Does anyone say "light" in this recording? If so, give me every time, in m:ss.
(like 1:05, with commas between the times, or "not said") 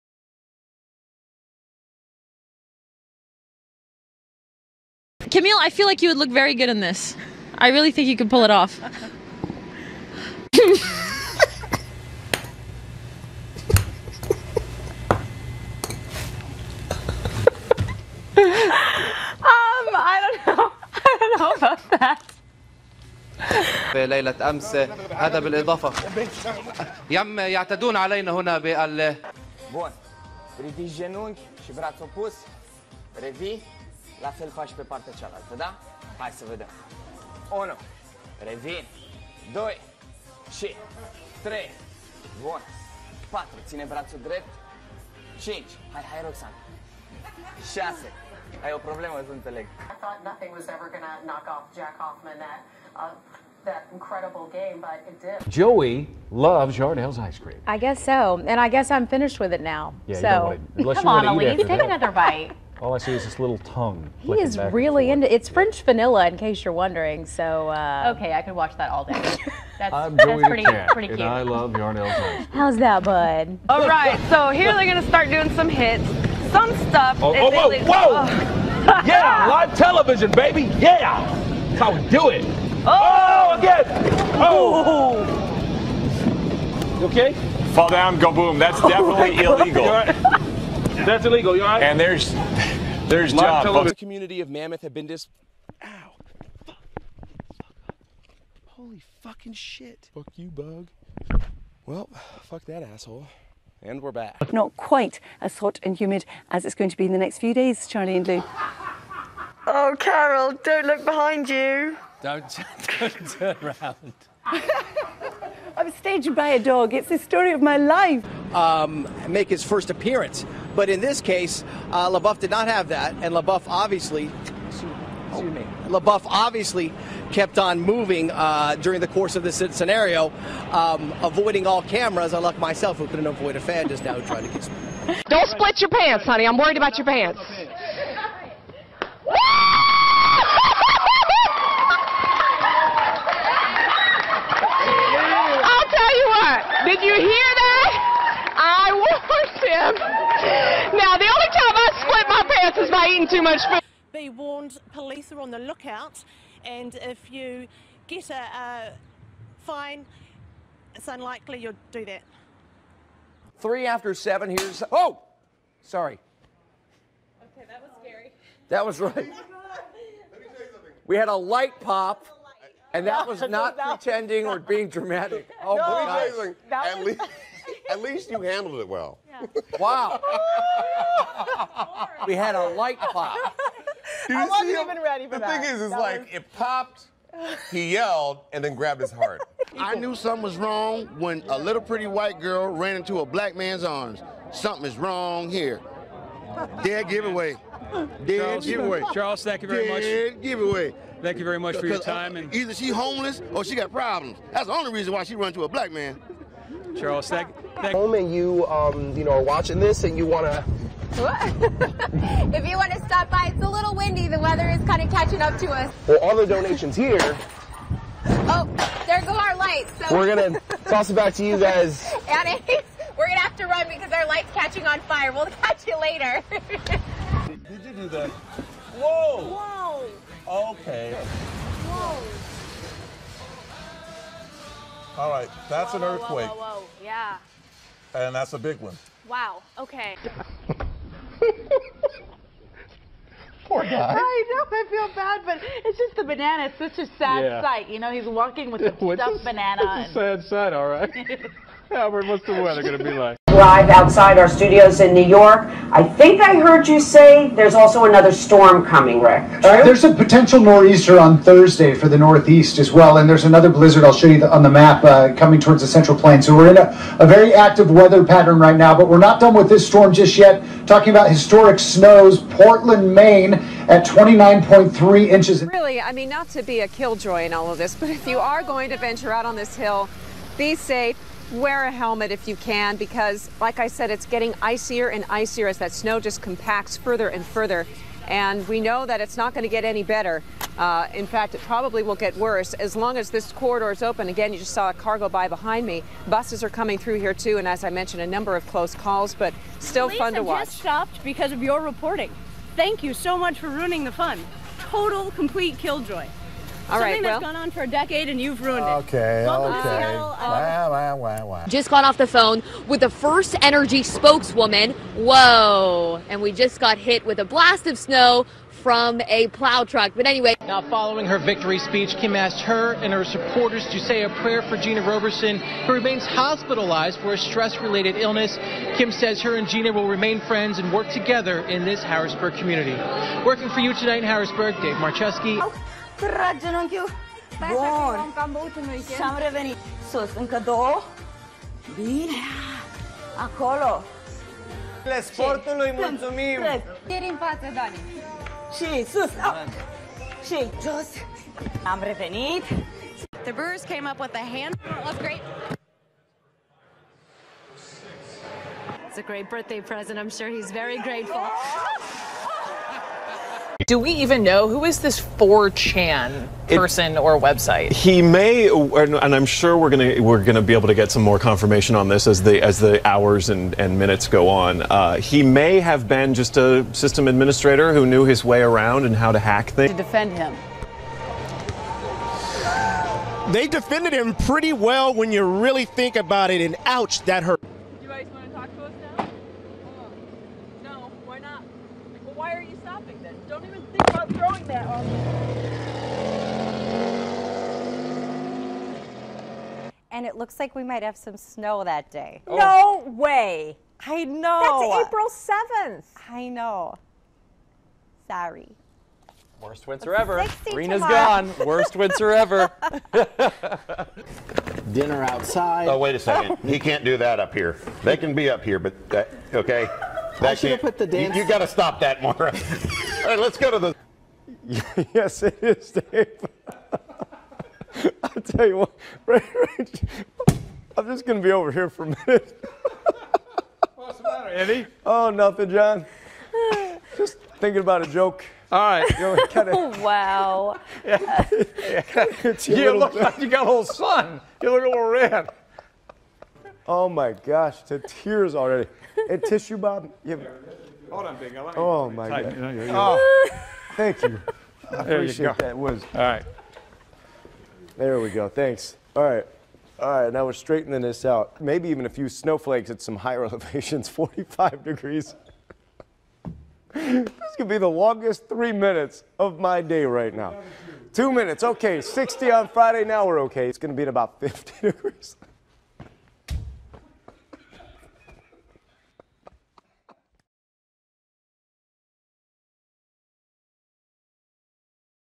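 2:51, 3:02, 3:39, 3:44.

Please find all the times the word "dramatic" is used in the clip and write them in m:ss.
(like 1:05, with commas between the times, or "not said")
2:54.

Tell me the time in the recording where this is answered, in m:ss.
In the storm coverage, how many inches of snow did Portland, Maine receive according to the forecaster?
4:34.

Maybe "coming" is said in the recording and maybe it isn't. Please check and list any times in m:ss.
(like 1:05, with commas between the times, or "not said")
4:18, 4:25, 4:56.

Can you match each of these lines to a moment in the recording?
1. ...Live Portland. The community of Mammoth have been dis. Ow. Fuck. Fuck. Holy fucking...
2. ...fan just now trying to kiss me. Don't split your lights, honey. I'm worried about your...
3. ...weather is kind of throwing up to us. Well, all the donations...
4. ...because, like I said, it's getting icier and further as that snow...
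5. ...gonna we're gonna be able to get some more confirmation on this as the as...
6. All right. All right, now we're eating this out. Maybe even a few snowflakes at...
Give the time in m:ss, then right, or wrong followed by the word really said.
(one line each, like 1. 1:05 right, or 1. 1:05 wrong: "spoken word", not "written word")
1. 1:33 wrong: "John", not "Portland"
2. 2:13 wrong: "pants", not "lights"
3. 3:34 wrong: "catching", not "throwing"
4. 4:42 wrong: "icier", not "further"
5. 6:09 right
6. 7:39 wrong: "straightening", not "eating".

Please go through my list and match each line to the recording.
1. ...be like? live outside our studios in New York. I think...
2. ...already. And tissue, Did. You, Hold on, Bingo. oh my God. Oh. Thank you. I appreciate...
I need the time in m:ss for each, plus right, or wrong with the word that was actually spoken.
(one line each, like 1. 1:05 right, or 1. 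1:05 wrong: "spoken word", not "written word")
1. 4:13 right
2. 7:28 wrong: "Bob", not "Did".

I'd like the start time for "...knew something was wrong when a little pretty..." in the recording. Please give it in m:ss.
3:09.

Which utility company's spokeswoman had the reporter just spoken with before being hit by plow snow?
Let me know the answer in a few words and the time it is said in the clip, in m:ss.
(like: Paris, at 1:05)
First Energy, at 5:13.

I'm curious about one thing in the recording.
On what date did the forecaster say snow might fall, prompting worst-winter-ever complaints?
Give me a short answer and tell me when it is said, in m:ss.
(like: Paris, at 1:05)
April 7th, at 6:45.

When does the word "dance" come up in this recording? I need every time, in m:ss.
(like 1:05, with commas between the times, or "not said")
7:01.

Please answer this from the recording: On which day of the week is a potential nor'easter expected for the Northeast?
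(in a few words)
Thursday.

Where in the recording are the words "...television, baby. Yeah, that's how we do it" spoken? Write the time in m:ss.
1:19.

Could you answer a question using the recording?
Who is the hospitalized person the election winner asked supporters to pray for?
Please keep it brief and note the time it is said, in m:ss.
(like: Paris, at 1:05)
Gina Roberson, at 5:24.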